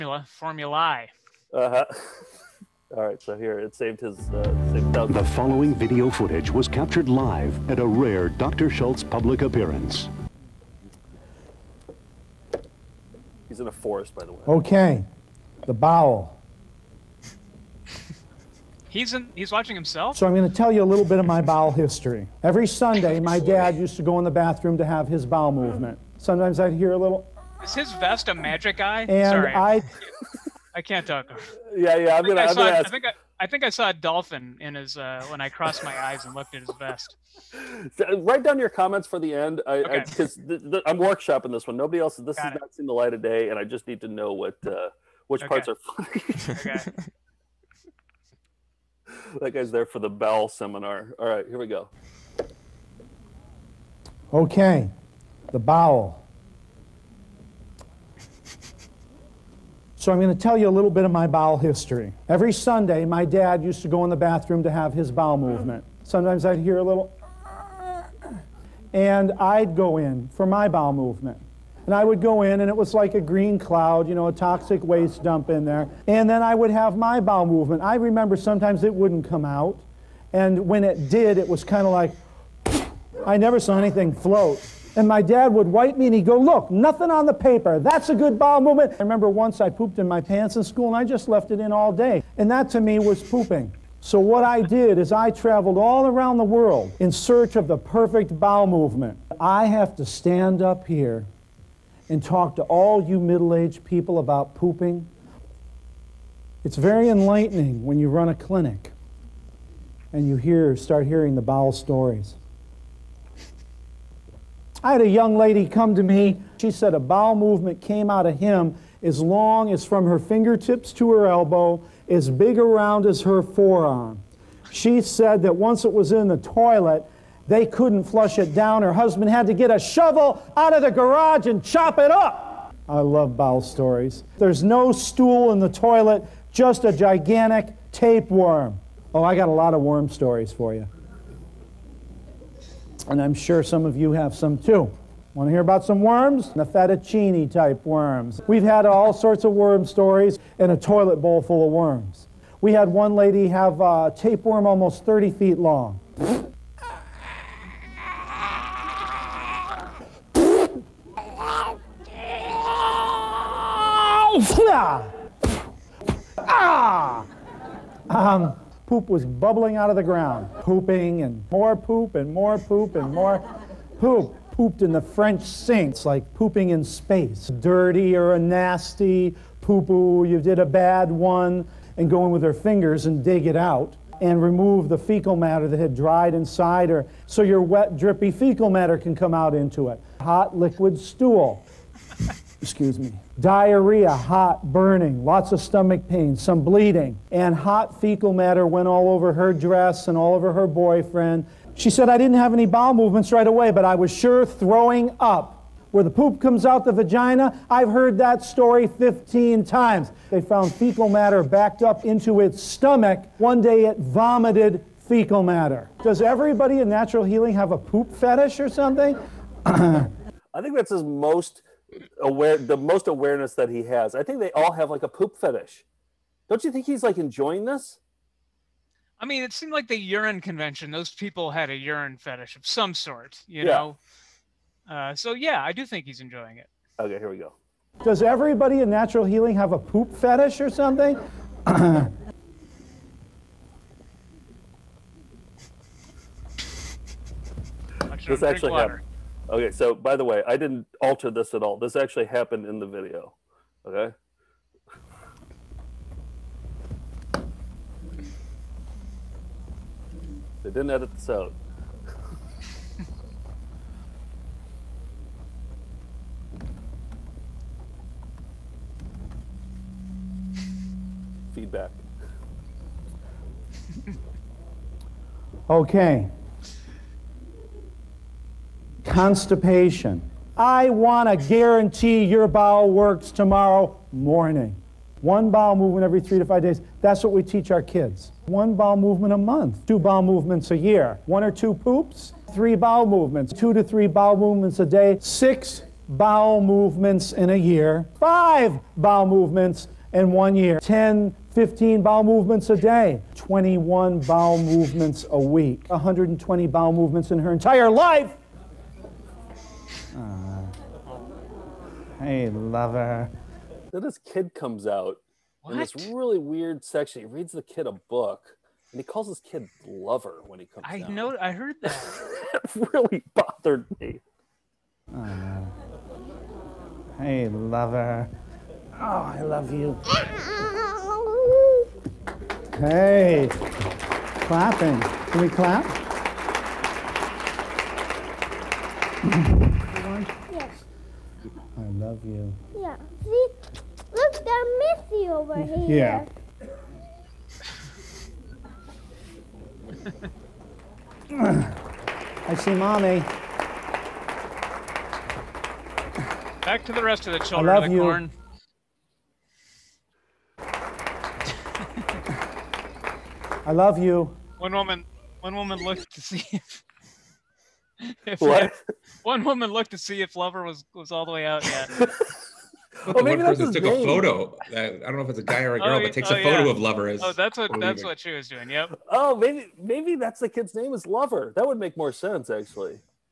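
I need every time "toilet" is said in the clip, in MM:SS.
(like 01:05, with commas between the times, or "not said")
02:06, 02:15, 02:30.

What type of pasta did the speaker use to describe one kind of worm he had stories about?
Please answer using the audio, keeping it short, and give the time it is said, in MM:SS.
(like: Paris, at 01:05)
Fettuccine, at 02:26.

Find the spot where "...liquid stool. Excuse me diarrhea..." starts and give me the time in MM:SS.
03:10.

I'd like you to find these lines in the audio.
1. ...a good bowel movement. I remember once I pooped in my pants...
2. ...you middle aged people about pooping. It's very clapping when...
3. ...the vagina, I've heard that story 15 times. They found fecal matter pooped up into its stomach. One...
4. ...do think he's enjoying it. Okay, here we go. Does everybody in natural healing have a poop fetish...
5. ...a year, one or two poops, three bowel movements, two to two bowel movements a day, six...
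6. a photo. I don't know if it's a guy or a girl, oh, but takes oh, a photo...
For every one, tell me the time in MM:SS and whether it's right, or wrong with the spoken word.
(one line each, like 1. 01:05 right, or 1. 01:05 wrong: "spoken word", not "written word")
1. 01:28 right
2. 01:43 wrong: "enlightening", not "clapping"
3. 03:26 wrong: "backed", not "pooped"
4. 03:55 right
5. 04:50 wrong: "three", not "two"
6. 06:14 right.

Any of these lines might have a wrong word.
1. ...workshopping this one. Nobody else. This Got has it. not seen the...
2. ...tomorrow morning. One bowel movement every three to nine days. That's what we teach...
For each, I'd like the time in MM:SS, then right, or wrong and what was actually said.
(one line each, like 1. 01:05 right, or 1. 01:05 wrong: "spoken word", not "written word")
1. 00:40 right
2. 04:43 wrong: "five", not "nine".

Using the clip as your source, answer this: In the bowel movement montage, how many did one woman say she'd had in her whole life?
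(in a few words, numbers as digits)
120.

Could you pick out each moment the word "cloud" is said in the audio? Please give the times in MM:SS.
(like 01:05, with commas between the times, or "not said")
01:13.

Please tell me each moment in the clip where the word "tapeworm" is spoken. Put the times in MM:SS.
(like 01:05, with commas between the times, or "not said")
02:17, 02:34.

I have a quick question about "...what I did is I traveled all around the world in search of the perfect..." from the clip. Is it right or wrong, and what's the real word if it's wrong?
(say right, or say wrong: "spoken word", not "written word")
right.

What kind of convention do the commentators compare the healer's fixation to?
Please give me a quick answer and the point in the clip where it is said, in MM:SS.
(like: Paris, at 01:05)
Urine convention, at 03:49.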